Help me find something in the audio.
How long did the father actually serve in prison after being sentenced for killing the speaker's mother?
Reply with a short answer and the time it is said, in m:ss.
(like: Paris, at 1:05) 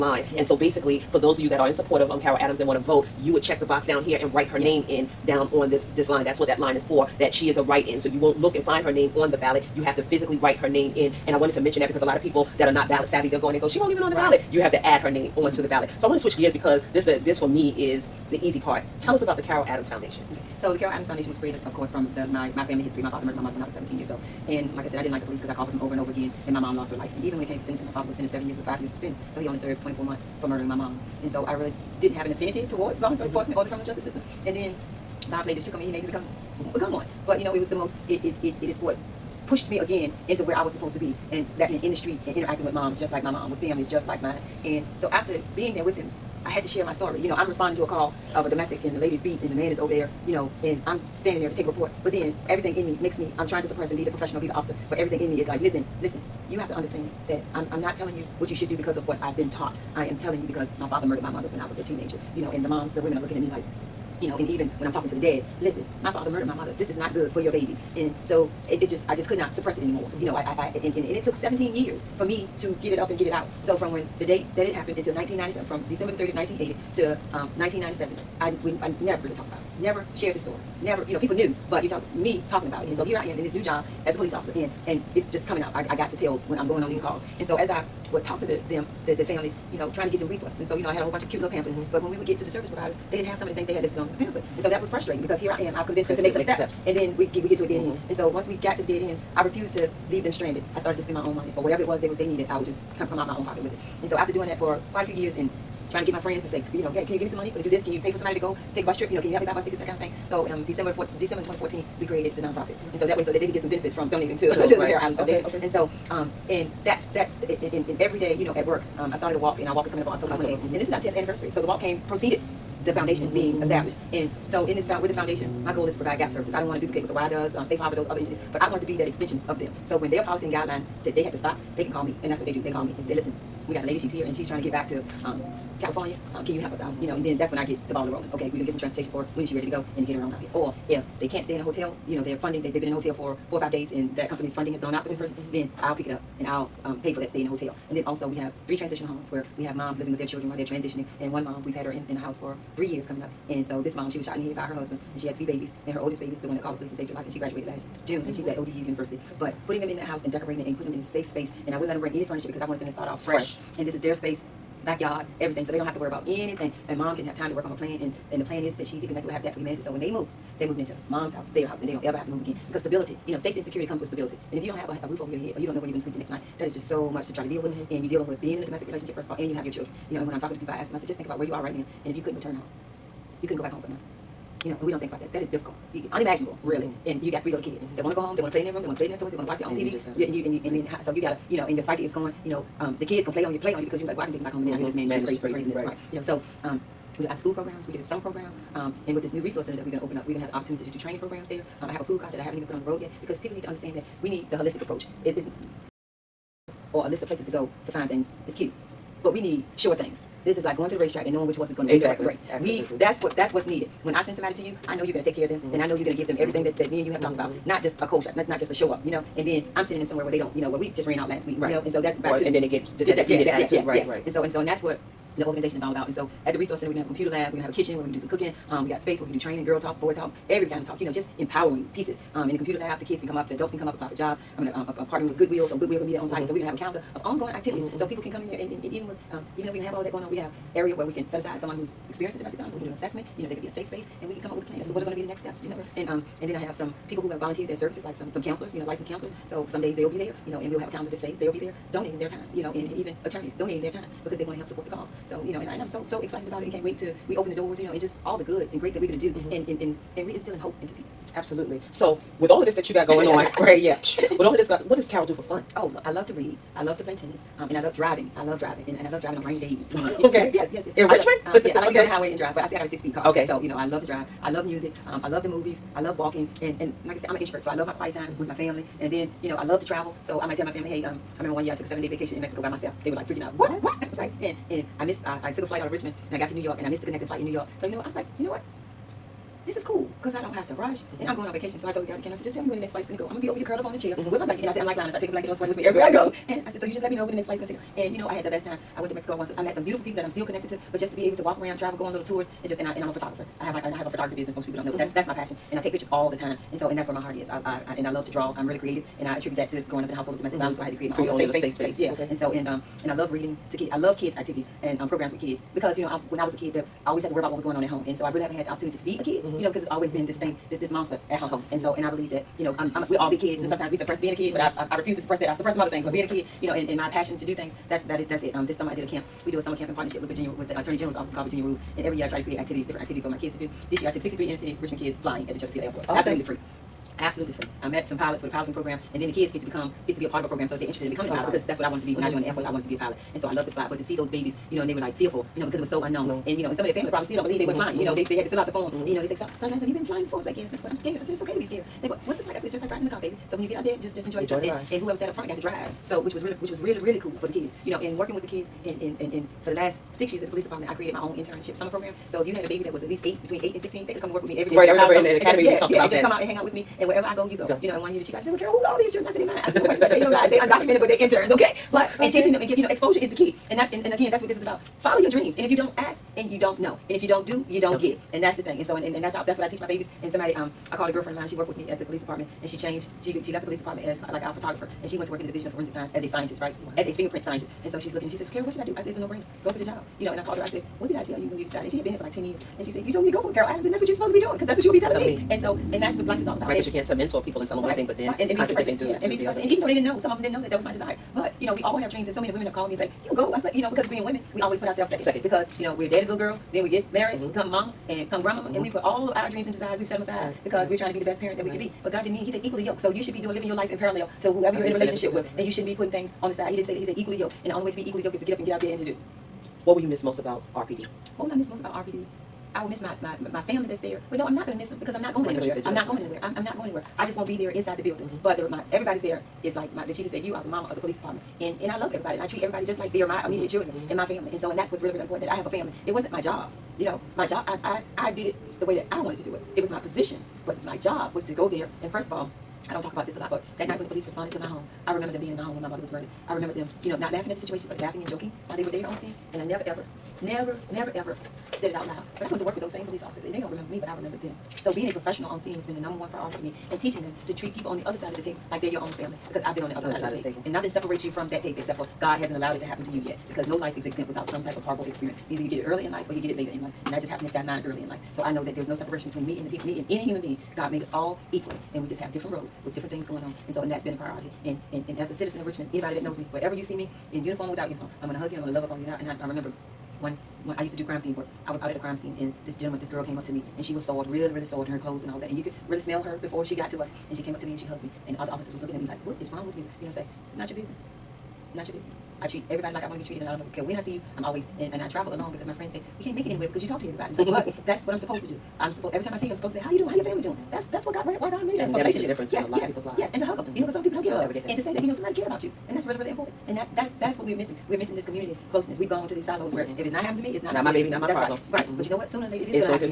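24 months, at 0:29.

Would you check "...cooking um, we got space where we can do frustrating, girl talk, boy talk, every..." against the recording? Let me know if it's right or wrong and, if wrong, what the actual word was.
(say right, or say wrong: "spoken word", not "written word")
wrong: "training", not "frustrating".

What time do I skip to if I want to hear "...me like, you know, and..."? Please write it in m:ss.
1:03.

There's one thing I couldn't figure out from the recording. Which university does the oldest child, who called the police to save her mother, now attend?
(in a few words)
ODU.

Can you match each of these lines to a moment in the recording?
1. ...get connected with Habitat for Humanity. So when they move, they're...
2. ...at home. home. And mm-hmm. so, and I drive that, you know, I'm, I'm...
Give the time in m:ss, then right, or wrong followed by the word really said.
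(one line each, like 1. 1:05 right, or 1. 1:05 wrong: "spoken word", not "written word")
1. 2:48 right
2. 5:21 wrong: "believe", not "drive".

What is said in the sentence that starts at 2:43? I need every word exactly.
fresh and this is their space, backyard, everything.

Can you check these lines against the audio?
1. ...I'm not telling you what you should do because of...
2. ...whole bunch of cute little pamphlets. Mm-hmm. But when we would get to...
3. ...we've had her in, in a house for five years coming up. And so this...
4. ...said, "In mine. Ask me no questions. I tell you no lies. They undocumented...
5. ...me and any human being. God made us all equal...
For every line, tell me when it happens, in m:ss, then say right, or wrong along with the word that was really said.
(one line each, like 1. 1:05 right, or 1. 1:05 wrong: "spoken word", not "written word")
1. 0:57 right
2. 1:31 right
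3. 2:31 wrong: "three", not "five"
4. 6:09 right
5. 7:49 right.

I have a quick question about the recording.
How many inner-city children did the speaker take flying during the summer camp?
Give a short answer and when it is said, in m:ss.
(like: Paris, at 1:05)
63, at 5:34.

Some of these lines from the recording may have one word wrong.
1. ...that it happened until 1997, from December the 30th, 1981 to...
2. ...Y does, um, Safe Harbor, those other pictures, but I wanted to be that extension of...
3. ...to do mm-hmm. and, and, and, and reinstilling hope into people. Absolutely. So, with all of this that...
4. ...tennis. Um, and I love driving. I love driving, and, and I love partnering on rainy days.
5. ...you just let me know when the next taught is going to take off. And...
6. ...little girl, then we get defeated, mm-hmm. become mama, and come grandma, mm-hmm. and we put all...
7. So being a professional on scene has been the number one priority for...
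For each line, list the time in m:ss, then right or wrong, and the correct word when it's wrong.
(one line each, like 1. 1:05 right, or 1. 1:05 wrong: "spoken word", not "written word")
1. 1:14 wrong: "1980", not "1981"
2. 2:07 wrong: "entities", not "pictures"
3. 4:19 right
4. 4:27 wrong: "driving", not "partnering"
5. 4:56 wrong: "flight", not "taught"
6. 6:46 wrong: "married", not "defeated"
7. 7:34 right.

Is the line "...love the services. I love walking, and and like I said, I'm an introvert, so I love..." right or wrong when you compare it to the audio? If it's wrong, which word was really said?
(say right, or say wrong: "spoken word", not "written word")
wrong: "movies", not "services".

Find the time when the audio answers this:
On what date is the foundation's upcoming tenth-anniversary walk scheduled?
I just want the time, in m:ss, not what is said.
2:00.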